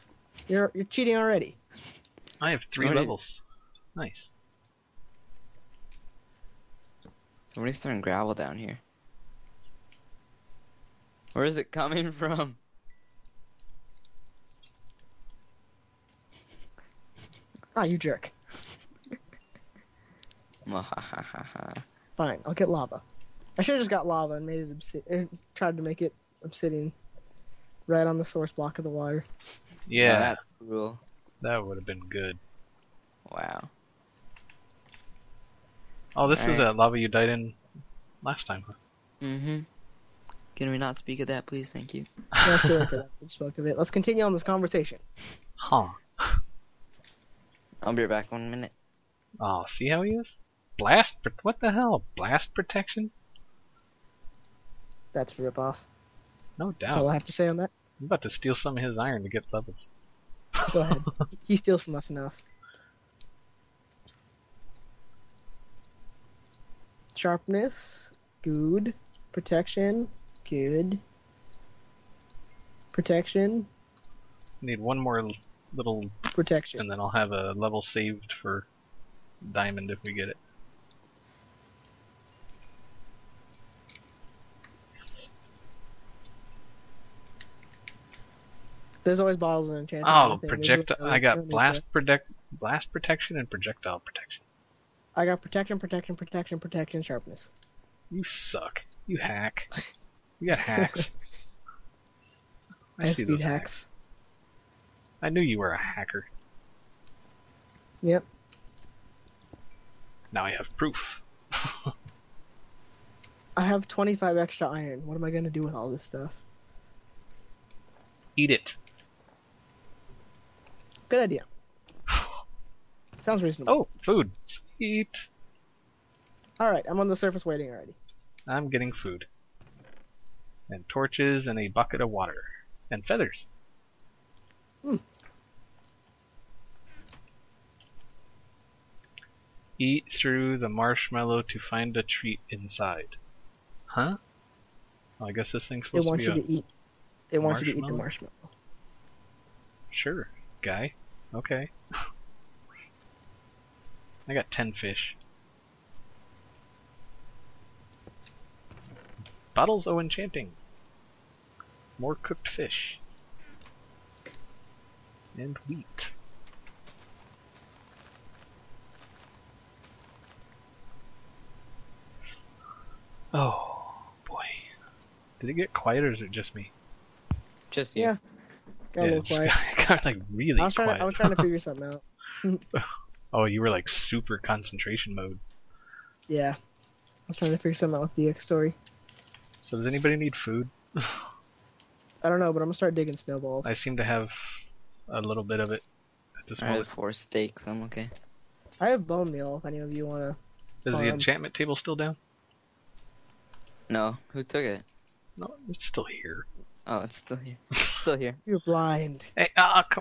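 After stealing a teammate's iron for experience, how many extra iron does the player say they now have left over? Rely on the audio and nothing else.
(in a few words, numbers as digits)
25.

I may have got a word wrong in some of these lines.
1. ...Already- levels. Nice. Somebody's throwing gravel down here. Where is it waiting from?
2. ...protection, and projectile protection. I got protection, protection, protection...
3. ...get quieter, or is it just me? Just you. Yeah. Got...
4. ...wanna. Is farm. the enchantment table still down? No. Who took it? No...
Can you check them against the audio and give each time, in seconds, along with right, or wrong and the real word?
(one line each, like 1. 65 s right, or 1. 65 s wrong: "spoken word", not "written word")
1. 2 s wrong: "coming", not "waiting"
2. 92 s right
3. 175 s right
4. 200 s right.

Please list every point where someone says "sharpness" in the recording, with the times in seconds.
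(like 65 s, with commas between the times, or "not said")
67 s, 97 s.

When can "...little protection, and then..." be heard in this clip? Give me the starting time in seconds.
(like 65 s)
75 s.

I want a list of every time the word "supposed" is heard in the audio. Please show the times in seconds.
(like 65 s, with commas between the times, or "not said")
145 s.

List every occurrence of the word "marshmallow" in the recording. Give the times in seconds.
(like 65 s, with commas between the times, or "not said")
140 s, 147 s.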